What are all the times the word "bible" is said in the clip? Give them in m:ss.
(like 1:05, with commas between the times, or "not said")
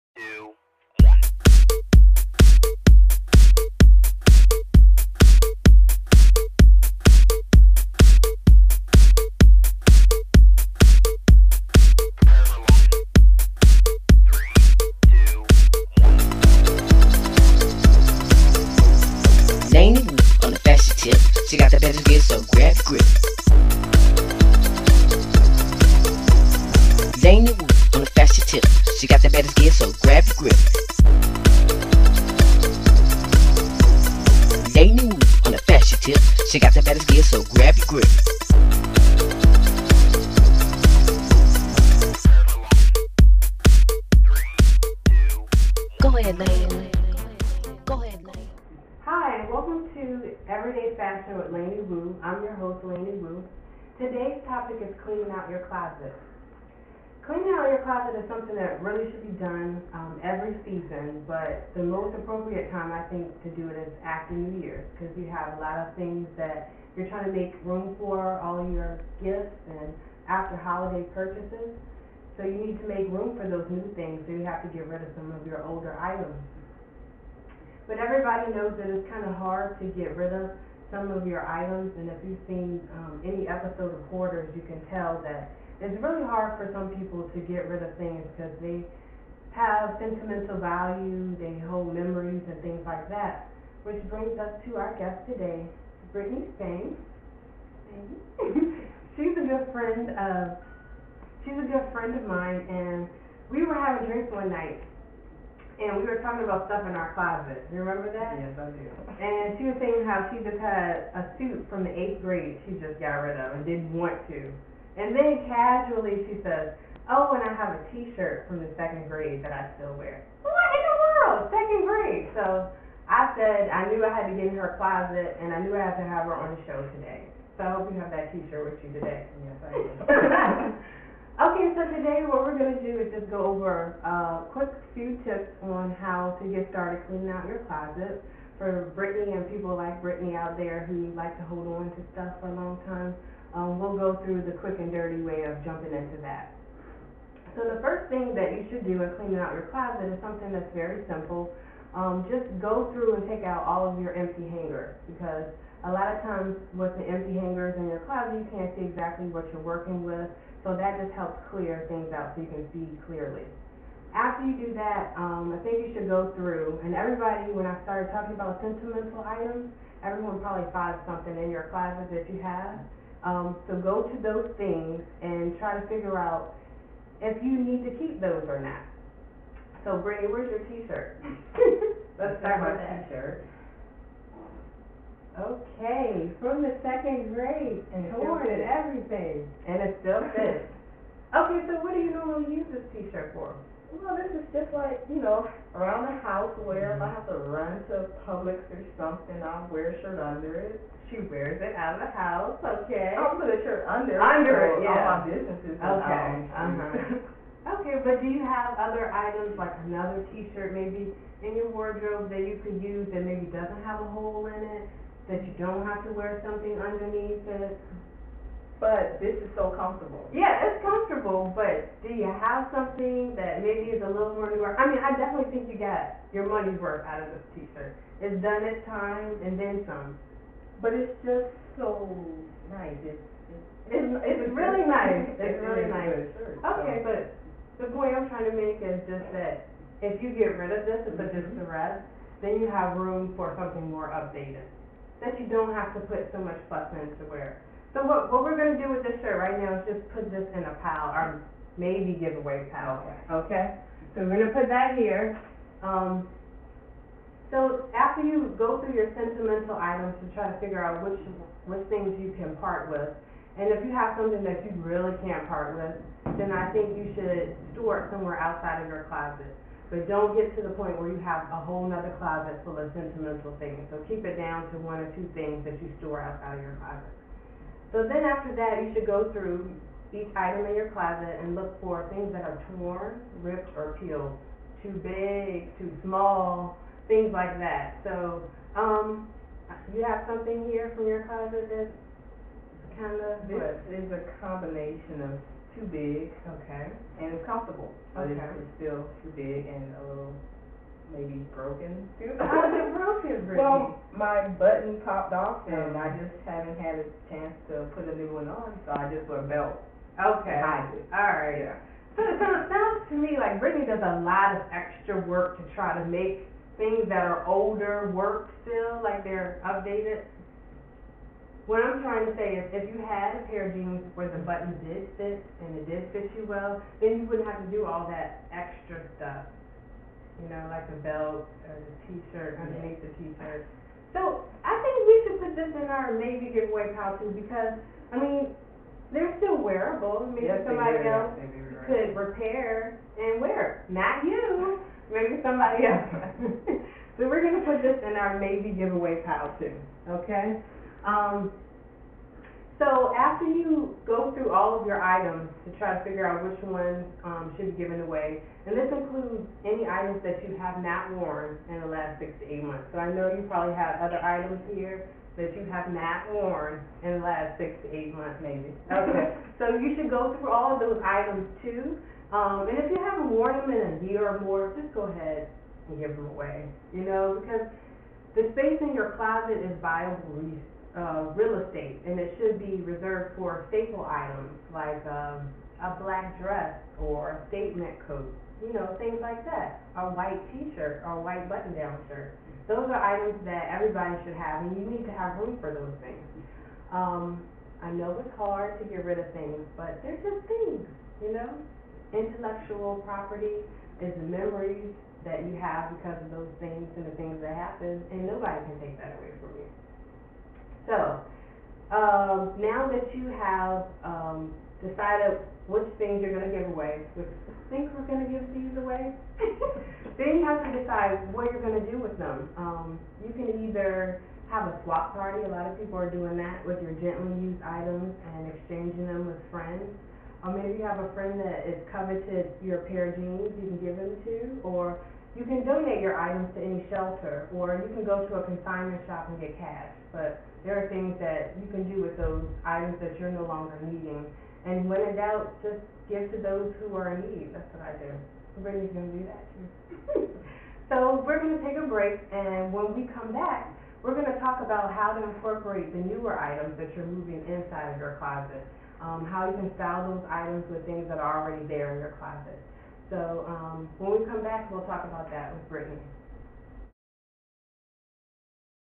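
not said.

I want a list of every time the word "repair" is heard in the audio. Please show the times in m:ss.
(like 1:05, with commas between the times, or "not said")
5:42.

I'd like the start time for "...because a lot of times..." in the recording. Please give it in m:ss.
2:35.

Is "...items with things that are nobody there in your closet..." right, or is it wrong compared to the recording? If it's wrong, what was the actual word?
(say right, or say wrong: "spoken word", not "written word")
wrong: "already", not "nobody".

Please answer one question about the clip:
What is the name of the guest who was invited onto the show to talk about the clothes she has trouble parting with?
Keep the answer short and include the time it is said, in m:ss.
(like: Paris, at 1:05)
Brittany Spain, at 1:36.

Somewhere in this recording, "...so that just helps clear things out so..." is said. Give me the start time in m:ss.
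2:40.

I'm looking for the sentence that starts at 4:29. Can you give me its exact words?
But don't get to the point where you have a whole nother closet full of sentimental things.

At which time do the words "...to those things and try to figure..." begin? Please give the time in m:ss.
2:54.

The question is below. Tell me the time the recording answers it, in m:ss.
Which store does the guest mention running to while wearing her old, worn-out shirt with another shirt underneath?
3:18.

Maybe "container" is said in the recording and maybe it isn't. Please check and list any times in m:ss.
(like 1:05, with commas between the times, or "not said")
not said.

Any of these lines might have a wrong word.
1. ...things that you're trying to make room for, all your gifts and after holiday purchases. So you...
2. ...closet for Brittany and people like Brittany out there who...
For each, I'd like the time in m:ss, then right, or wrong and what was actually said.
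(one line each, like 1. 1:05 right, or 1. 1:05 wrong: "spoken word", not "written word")
1. 1:05 right
2. 2:17 right.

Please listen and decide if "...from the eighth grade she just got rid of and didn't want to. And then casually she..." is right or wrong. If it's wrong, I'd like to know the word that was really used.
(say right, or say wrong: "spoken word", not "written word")
right.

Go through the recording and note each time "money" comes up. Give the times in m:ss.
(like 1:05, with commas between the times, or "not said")
3:46.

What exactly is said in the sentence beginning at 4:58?
it's still too big and a little maybe broken.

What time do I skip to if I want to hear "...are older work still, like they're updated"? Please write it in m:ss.
5:17.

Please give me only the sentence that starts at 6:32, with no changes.
Those are items that everybody should have, and you need to have room for those things.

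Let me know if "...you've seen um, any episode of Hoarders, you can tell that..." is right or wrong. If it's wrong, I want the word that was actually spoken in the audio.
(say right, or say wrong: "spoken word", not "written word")
right.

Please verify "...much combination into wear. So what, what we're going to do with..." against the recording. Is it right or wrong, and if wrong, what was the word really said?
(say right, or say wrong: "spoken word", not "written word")
wrong: "button", not "combination".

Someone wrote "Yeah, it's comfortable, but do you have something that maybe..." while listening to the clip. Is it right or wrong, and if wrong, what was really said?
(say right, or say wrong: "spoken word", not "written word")
right.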